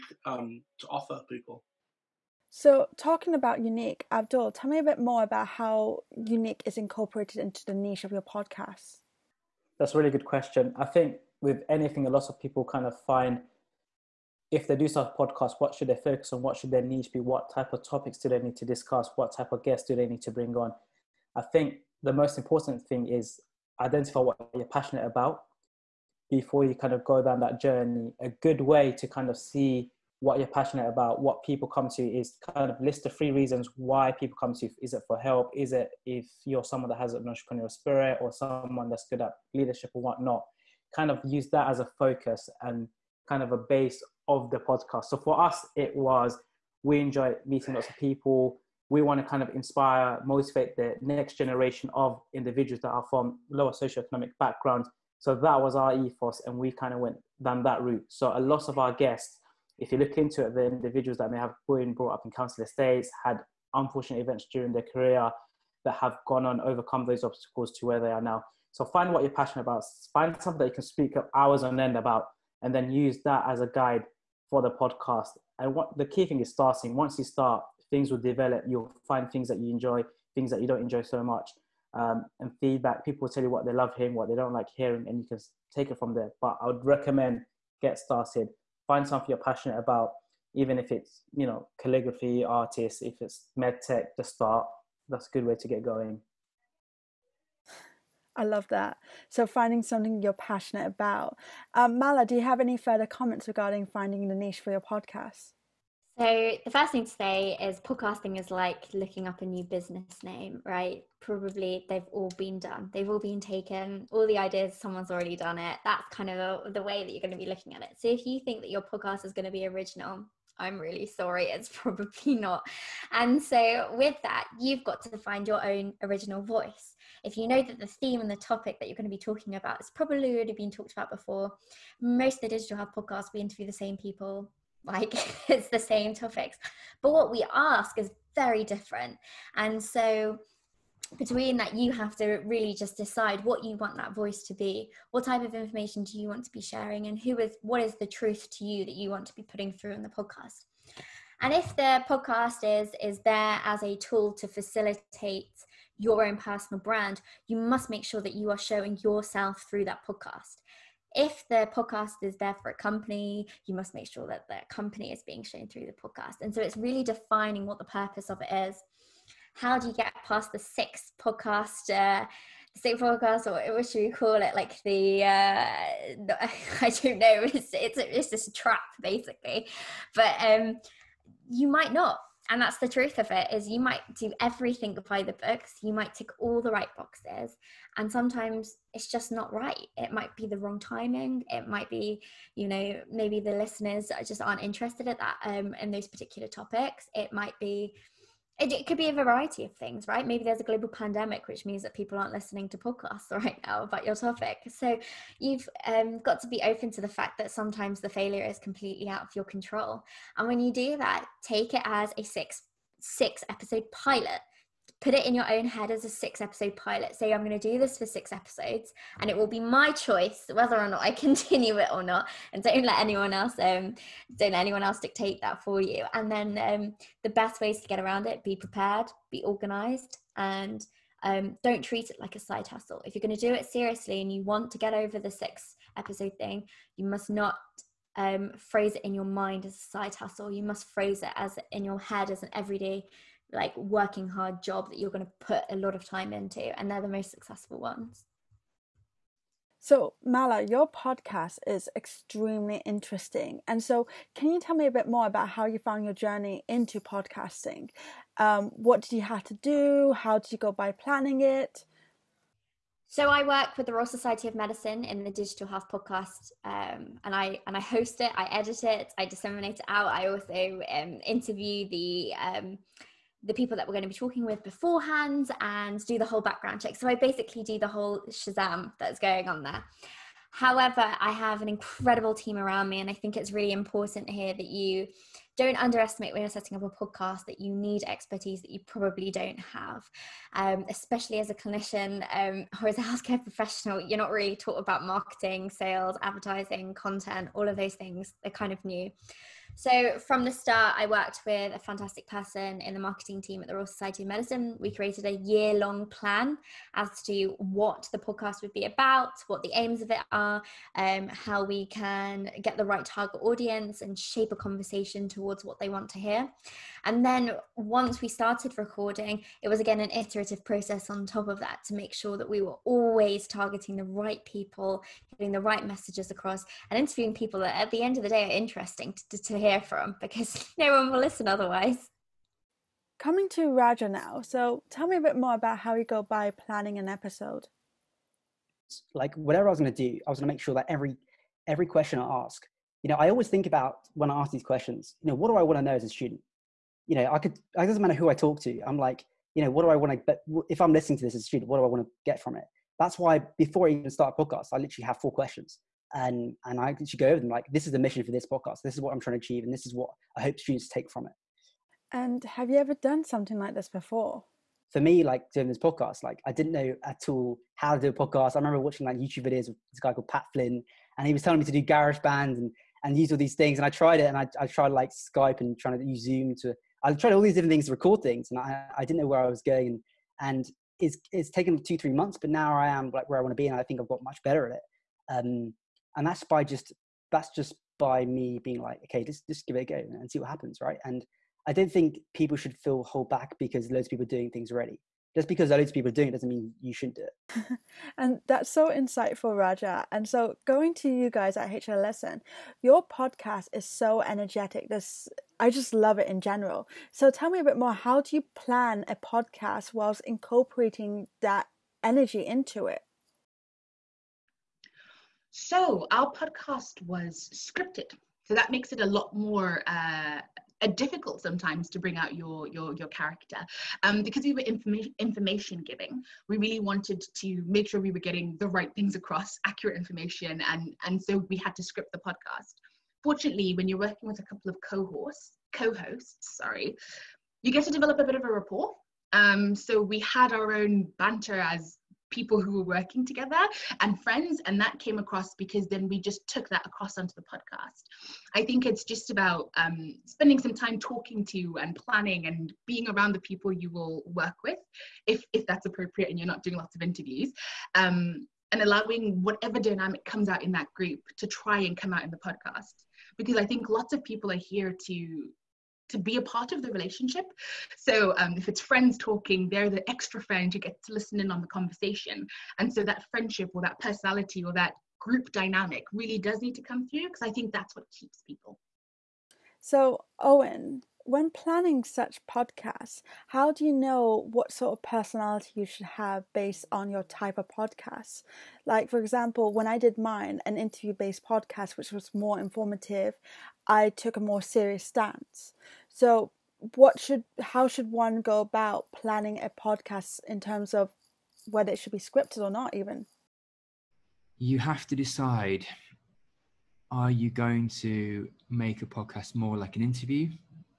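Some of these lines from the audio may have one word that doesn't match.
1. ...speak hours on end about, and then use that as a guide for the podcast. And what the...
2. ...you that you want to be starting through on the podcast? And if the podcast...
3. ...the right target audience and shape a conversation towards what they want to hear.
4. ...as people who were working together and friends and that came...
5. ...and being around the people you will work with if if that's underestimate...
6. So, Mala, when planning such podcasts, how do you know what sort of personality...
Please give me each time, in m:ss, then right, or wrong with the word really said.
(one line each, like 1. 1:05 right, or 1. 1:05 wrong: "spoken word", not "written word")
1. 1:10 right
2. 2:28 wrong: "putting", not "starting"
3. 5:12 right
4. 7:21 right
5. 7:32 wrong: "appropriate", not "underestimate"
6. 7:59 wrong: "Owen", not "Mala".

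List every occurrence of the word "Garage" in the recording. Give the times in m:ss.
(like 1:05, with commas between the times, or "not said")
6:11.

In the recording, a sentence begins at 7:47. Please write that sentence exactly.
So um, if it's friends talking, they're the extra friend who gets to listen in on the conversation.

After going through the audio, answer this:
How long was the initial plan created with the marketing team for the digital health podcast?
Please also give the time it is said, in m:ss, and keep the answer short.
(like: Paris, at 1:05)
A year, at 5:05.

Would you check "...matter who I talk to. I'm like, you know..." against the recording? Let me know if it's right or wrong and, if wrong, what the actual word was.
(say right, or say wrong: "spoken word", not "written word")
right.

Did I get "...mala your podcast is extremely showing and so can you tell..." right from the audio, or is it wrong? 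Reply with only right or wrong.
wrong.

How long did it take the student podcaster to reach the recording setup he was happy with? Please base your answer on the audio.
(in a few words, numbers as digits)
2-3 months.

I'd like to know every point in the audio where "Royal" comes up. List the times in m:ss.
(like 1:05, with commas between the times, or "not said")
4:23, 5:03.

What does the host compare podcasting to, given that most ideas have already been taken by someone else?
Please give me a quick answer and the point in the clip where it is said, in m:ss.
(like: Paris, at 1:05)
Looking up a new business name, at 1:48.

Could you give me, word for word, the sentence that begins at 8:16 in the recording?
So, what should how should one go about planning a podcast in terms of whether it should be scripted or not even?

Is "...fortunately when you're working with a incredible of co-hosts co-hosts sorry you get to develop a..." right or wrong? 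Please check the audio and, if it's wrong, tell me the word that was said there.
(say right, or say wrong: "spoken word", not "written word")
wrong: "couple", not "incredible".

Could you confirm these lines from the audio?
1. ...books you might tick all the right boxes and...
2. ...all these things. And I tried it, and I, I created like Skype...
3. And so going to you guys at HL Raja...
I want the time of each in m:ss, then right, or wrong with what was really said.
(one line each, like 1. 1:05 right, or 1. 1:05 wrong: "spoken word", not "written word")
1. 3:05 right
2. 6:13 wrong: "tried", not "created"
3. 6:40 wrong: "Lesson", not "Raja".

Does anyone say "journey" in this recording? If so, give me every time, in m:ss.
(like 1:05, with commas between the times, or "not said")
0:27, 4:16.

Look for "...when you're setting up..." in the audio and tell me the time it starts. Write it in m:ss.
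4:46.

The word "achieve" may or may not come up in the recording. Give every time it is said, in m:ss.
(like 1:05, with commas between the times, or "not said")
5:59.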